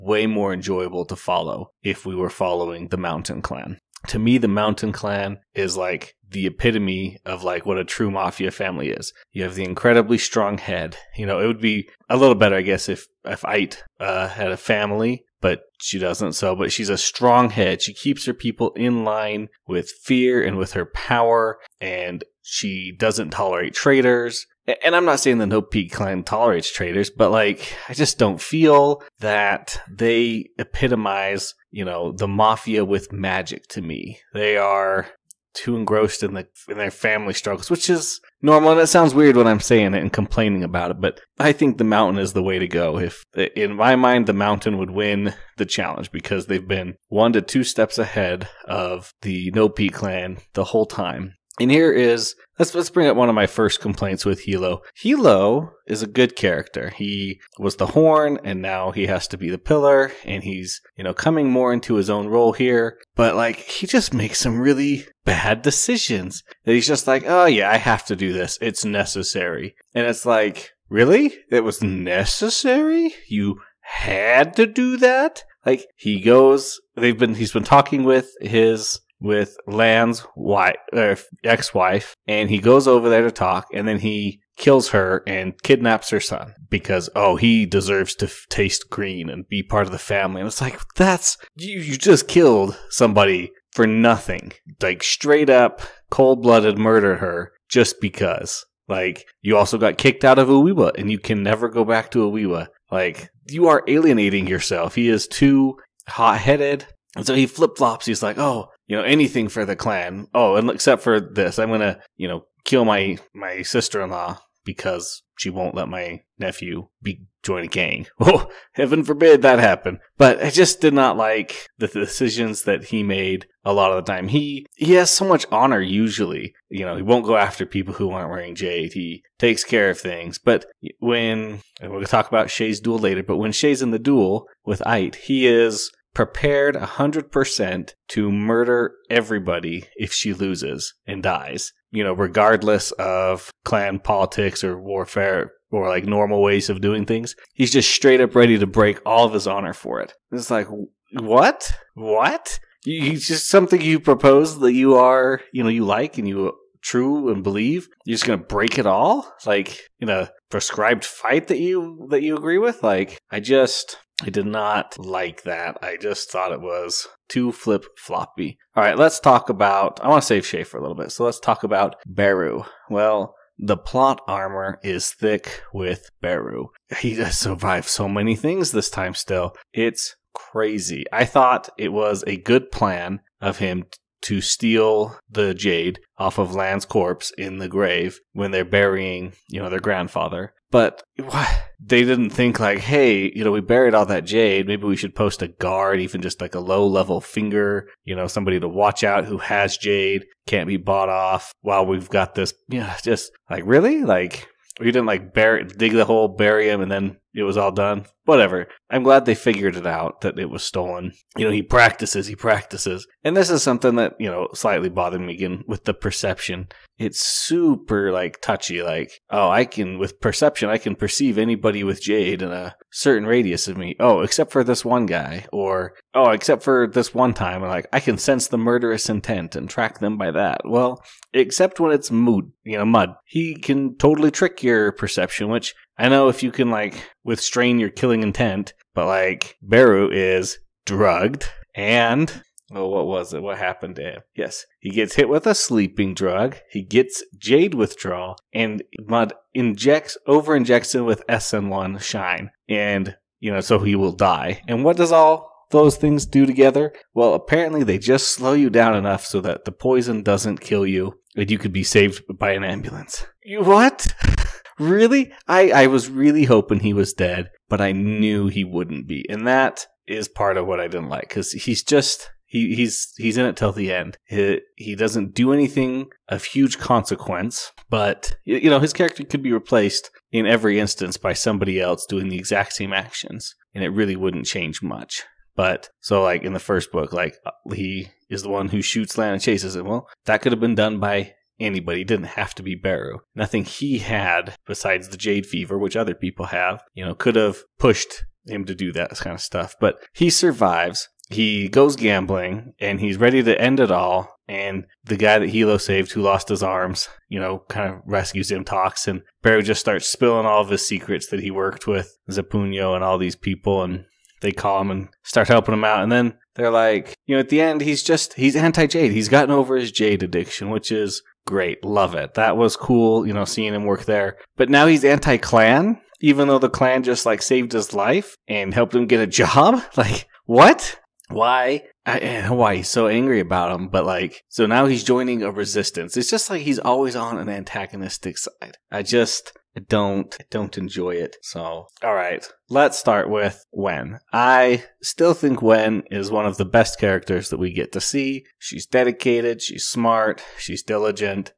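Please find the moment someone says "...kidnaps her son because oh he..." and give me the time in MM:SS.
01:25.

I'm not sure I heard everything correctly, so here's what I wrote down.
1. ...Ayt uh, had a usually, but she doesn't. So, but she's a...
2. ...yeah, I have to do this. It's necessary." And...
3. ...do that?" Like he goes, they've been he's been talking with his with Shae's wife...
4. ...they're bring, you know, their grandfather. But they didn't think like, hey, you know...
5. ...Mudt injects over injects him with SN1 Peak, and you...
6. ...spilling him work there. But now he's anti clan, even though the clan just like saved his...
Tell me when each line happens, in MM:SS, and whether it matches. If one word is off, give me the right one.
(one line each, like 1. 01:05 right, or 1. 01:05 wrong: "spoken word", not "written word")
1. 00:13 wrong: "family", not "usually"
2. 01:07 right
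3. 01:14 wrong: "Lan", not "Shae"
4. 03:08 wrong: "burying", not "bring"
5. 04:09 wrong: "Shine", not "Peak"
6. 05:23 wrong: "seeing", not "spilling".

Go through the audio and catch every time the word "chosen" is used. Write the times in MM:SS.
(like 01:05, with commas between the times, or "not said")
not said.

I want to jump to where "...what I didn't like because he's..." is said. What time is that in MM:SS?
04:30.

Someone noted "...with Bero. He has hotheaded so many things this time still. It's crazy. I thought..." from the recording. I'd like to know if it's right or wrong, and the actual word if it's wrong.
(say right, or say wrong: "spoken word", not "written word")
wrong: "survived", not "hotheaded".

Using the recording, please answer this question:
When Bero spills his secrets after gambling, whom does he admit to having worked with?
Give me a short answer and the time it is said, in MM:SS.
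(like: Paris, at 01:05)
Zapunyo, at 05:12.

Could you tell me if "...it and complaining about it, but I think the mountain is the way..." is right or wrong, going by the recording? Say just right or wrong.
right.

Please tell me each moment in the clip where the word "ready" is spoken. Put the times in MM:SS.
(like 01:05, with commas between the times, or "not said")
02:28, 05:03.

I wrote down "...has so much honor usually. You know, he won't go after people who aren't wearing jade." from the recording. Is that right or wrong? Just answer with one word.
right.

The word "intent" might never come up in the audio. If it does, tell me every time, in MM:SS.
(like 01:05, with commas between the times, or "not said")
03:49, 03:58.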